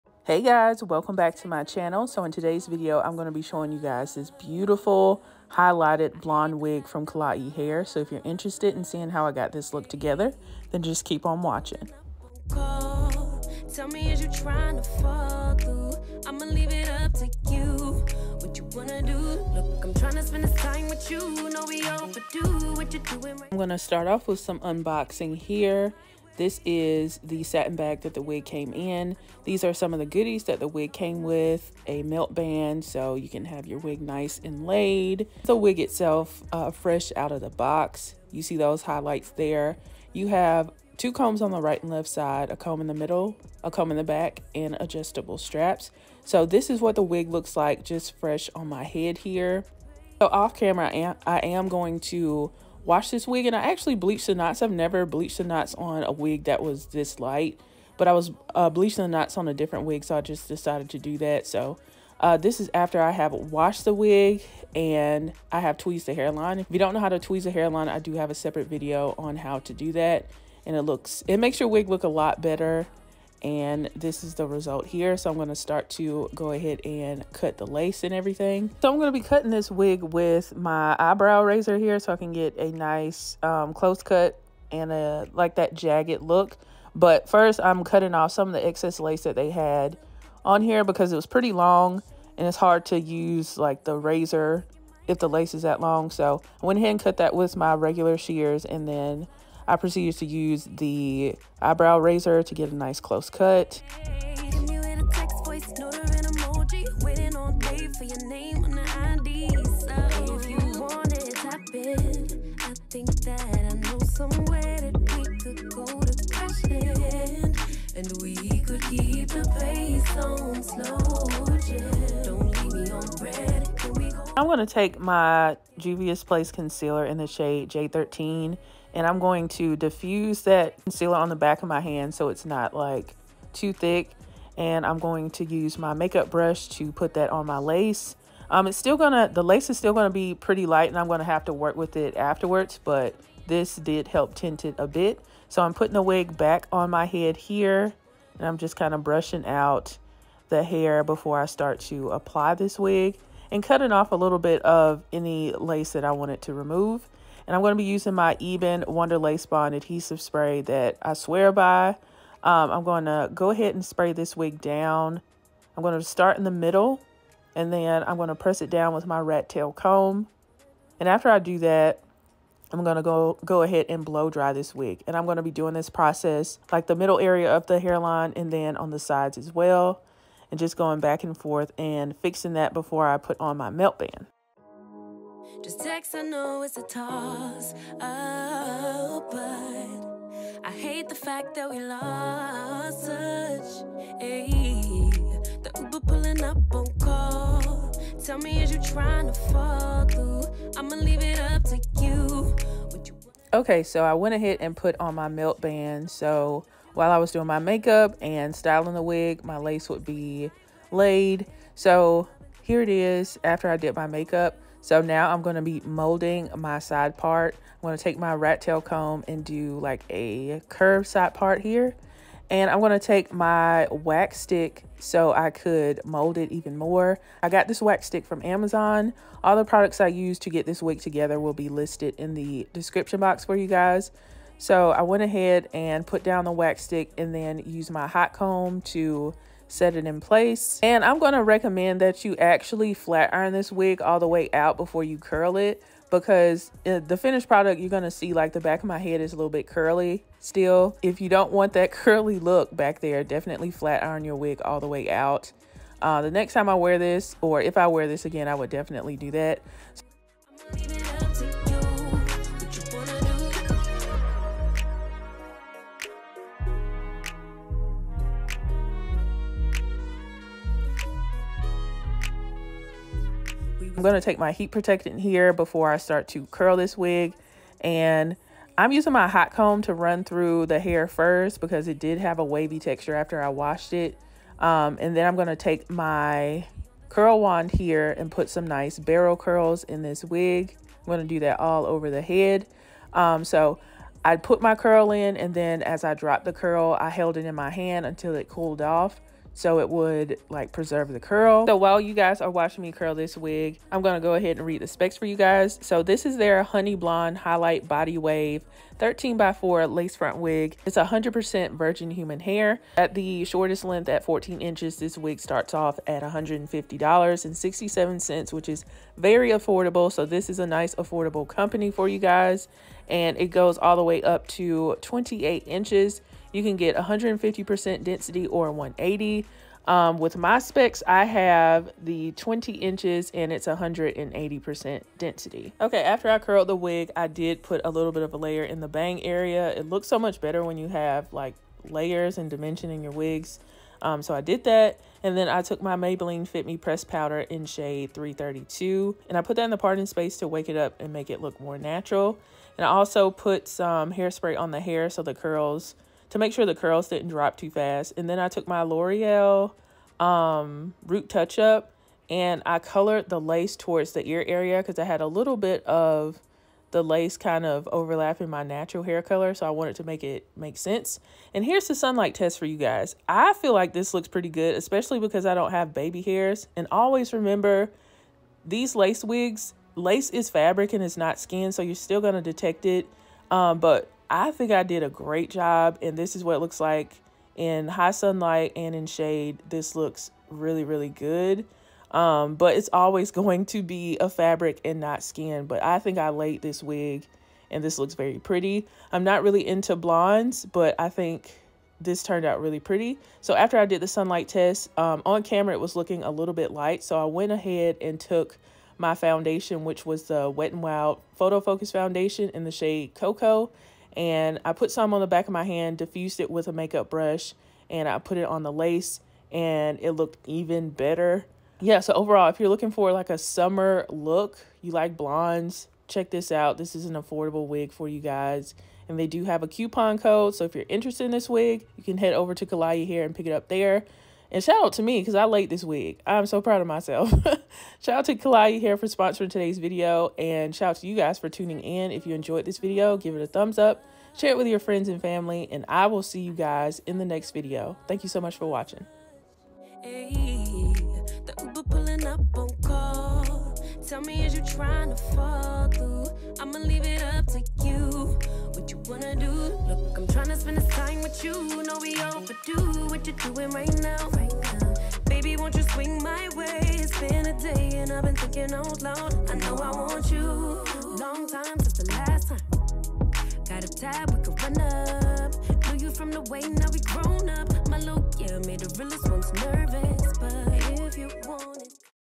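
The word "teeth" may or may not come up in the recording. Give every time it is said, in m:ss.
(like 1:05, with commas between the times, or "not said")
not said.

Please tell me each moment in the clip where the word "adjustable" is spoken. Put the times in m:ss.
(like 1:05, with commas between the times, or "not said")
0:44.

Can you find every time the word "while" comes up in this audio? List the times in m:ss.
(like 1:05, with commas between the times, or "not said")
3:26, 5:01.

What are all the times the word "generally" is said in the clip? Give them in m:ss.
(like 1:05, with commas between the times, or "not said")
not said.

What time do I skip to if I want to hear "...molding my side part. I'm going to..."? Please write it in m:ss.
3:35.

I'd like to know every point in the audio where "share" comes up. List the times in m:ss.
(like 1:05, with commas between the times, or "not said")
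7:24.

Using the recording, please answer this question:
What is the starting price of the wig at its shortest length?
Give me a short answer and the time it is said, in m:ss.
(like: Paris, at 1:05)
$150.67, at 5:16.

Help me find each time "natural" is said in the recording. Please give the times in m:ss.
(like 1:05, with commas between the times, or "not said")
5:51, 6:08.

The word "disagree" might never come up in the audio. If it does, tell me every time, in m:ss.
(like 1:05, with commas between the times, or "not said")
not said.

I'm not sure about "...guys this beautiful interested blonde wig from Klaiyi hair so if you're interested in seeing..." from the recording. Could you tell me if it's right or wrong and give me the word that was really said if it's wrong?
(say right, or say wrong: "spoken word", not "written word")
wrong: "highlighted", not "interested".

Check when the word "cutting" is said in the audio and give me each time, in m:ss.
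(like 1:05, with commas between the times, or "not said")
1:19, 1:27, 2:33.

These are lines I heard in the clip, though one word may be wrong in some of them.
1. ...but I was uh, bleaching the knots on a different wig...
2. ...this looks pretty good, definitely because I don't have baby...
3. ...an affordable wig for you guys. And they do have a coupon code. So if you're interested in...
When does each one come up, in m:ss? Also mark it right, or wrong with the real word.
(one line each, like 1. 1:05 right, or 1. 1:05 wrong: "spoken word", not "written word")
1. 0:57 right
2. 6:13 wrong: "especially", not "definitely"
3. 7:07 right.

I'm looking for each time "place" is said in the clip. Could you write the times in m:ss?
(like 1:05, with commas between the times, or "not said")
4:00.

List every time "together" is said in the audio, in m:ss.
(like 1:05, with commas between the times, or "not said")
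0:09, 3:50.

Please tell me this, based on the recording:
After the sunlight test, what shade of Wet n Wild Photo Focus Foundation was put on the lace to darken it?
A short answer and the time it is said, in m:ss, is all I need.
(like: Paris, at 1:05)
Cocoa, at 6:53.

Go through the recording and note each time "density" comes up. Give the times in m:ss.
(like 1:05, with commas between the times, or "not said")
5:28, 5:35.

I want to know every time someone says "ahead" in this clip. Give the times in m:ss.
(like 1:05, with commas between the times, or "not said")
1:16, 1:36, 2:43, 2:53, 3:24, 3:55, 5:04, 6:47.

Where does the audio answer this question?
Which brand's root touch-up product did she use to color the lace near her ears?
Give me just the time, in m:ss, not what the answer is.
5:58.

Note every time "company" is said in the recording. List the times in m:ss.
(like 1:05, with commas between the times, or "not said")
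5:21.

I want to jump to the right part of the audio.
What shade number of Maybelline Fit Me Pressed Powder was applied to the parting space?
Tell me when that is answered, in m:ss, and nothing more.
5:48.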